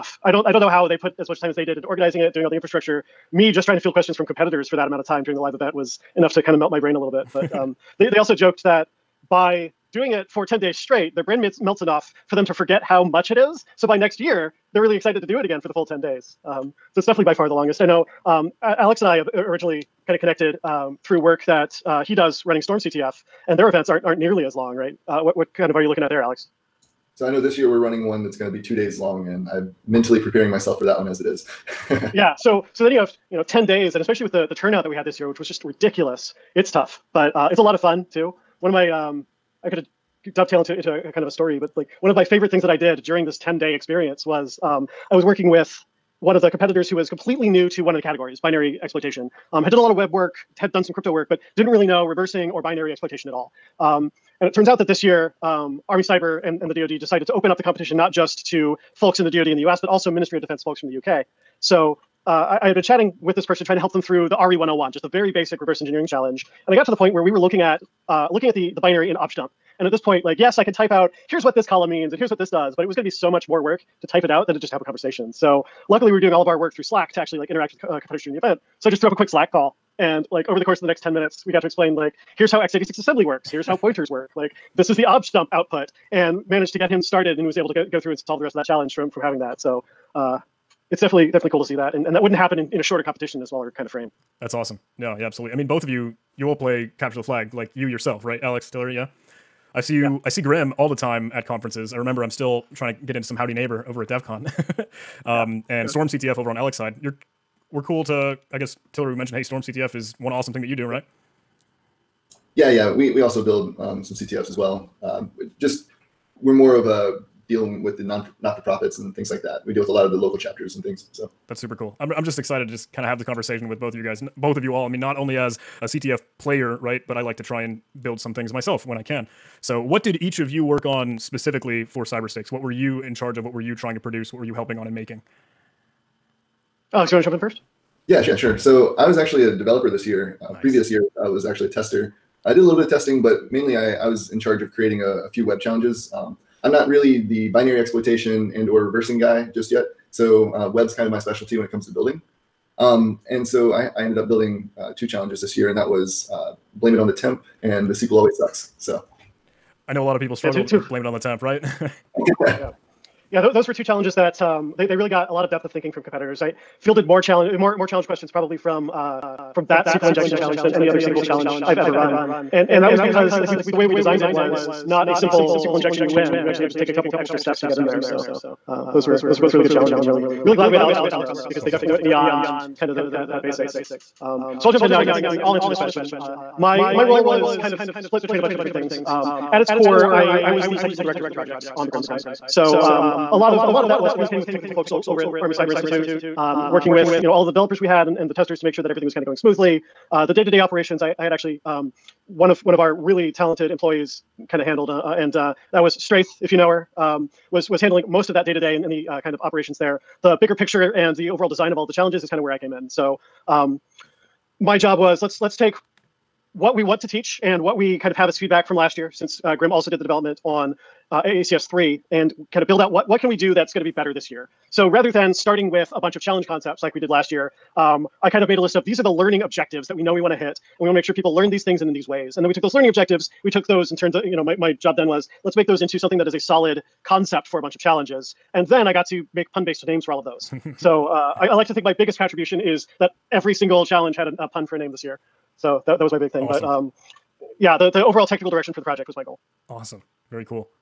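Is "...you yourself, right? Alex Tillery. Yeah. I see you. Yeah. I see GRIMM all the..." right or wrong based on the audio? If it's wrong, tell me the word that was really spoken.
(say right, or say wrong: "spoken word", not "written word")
right.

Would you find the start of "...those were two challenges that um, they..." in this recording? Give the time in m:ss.
2:43.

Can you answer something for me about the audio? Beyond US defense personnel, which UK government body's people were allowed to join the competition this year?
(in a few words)
Ministry of Defense.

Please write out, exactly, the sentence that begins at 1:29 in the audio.
So uh, it's definitely, definitely cool to see that.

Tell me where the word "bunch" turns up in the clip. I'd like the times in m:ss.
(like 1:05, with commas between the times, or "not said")
3:08, 3:46, 3:57.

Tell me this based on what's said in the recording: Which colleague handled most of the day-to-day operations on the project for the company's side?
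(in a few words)
Straith.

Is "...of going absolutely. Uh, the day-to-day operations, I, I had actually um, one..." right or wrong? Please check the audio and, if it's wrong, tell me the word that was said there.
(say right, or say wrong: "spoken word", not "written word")
wrong: "smoothly", not "absolutely".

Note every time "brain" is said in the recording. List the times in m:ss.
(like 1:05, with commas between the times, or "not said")
0:06, 0:11.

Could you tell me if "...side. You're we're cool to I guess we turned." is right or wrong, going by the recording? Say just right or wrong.
wrong.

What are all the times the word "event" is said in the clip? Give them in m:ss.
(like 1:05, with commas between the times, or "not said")
0:05, 0:23, 1:18.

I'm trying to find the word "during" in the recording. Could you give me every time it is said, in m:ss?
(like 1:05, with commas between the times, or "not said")
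0:05, 0:43, 1:18.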